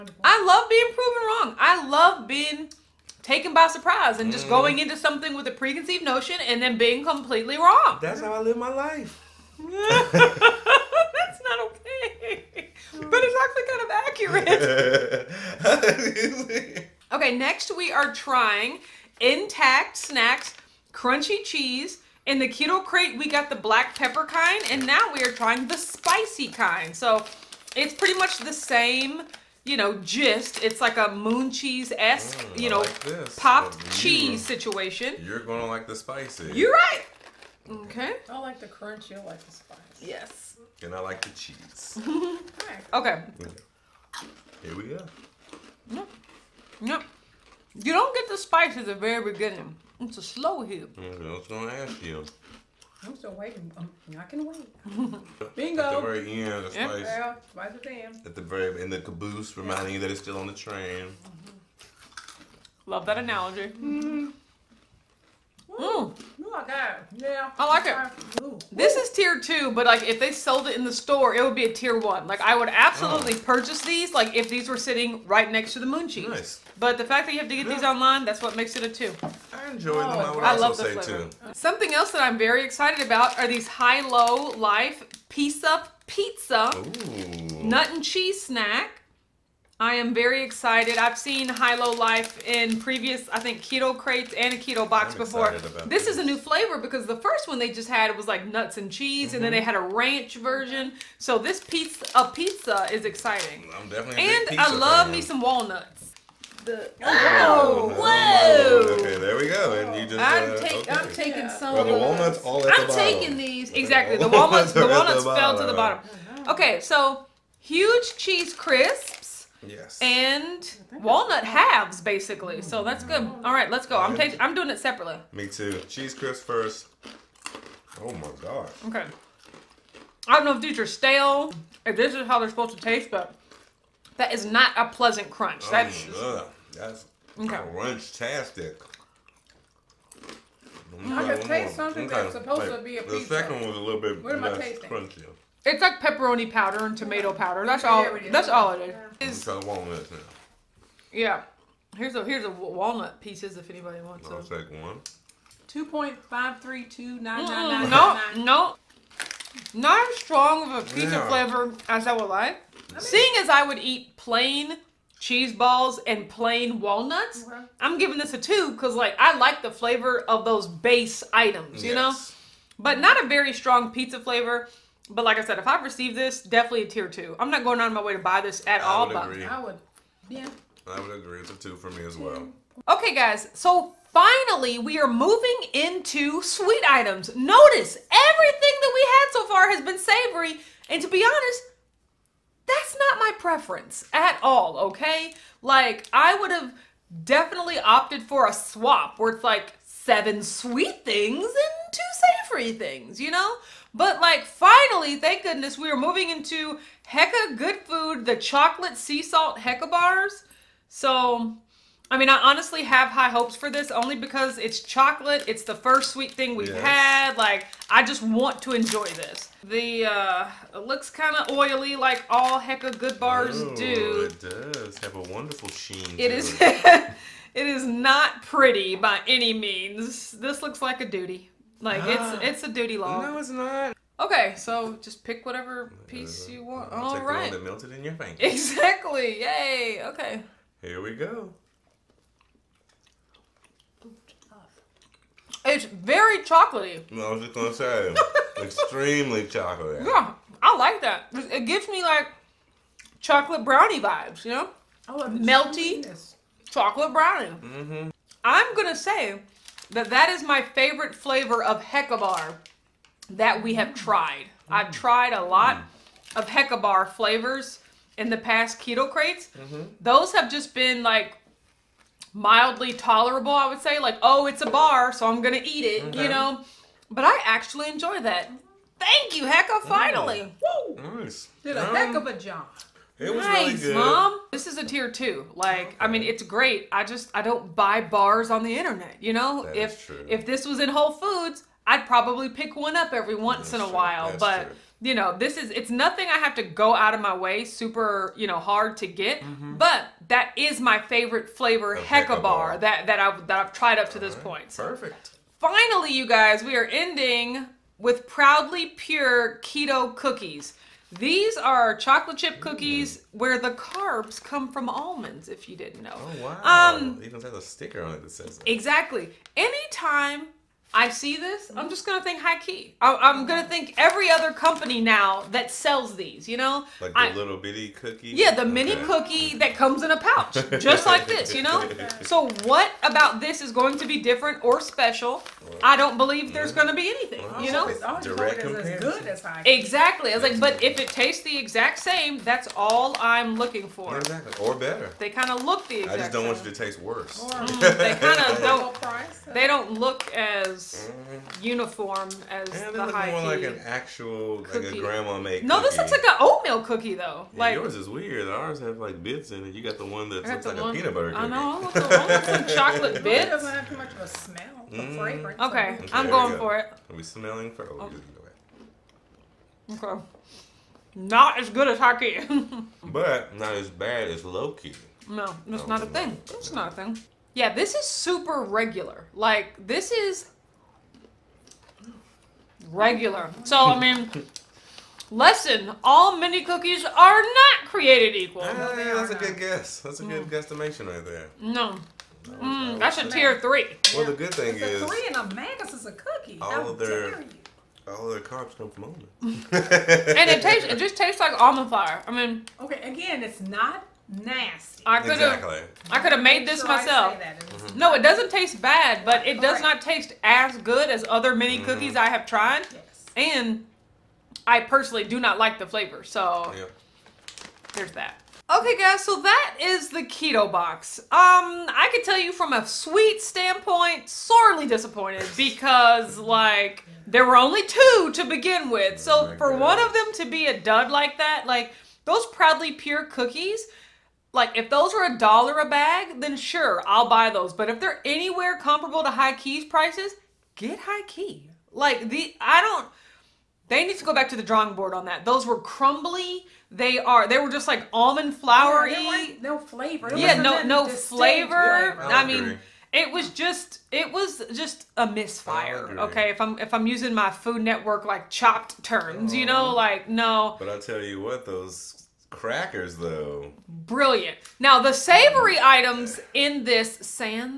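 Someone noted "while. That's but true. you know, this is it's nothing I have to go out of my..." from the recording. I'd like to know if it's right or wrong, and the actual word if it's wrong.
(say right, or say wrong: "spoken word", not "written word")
right.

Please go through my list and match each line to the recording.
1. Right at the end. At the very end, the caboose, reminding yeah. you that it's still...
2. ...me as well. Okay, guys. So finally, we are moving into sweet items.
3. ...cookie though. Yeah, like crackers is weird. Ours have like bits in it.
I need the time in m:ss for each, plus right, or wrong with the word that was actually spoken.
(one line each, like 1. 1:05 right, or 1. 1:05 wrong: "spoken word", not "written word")
1. 0:57 right
2. 3:01 right
3. 5:56 wrong: "yours", not "crackers".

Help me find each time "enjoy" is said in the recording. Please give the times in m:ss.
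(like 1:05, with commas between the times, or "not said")
1:19, 3:38, 4:37.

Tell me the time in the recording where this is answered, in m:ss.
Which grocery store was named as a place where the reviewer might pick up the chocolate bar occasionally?
4:50.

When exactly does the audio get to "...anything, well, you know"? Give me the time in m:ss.
5:37.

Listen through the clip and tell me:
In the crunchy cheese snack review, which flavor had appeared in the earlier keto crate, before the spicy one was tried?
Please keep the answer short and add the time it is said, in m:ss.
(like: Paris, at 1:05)
black pepper, at 0:23.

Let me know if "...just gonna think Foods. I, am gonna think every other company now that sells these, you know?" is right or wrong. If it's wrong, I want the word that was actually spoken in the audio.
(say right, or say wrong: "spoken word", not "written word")
wrong: "HighKey", not "Foods".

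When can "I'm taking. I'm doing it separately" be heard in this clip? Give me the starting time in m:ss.
2:03.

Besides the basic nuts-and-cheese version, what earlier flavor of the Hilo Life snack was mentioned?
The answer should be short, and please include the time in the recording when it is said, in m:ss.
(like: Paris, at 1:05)
ranch, at 1:39.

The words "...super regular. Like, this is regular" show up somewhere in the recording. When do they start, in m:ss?
6:18.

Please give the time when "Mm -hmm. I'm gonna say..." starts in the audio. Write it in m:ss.
4:17.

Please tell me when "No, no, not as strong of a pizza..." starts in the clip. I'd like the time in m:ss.
2:37.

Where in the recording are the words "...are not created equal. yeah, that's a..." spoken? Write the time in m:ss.
6:27.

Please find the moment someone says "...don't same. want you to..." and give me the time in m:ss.
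5:46.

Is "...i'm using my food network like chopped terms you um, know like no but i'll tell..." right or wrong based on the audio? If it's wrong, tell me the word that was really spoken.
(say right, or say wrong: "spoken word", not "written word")
right.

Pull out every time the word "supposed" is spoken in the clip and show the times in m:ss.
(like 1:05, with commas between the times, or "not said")
2:12, 2:22.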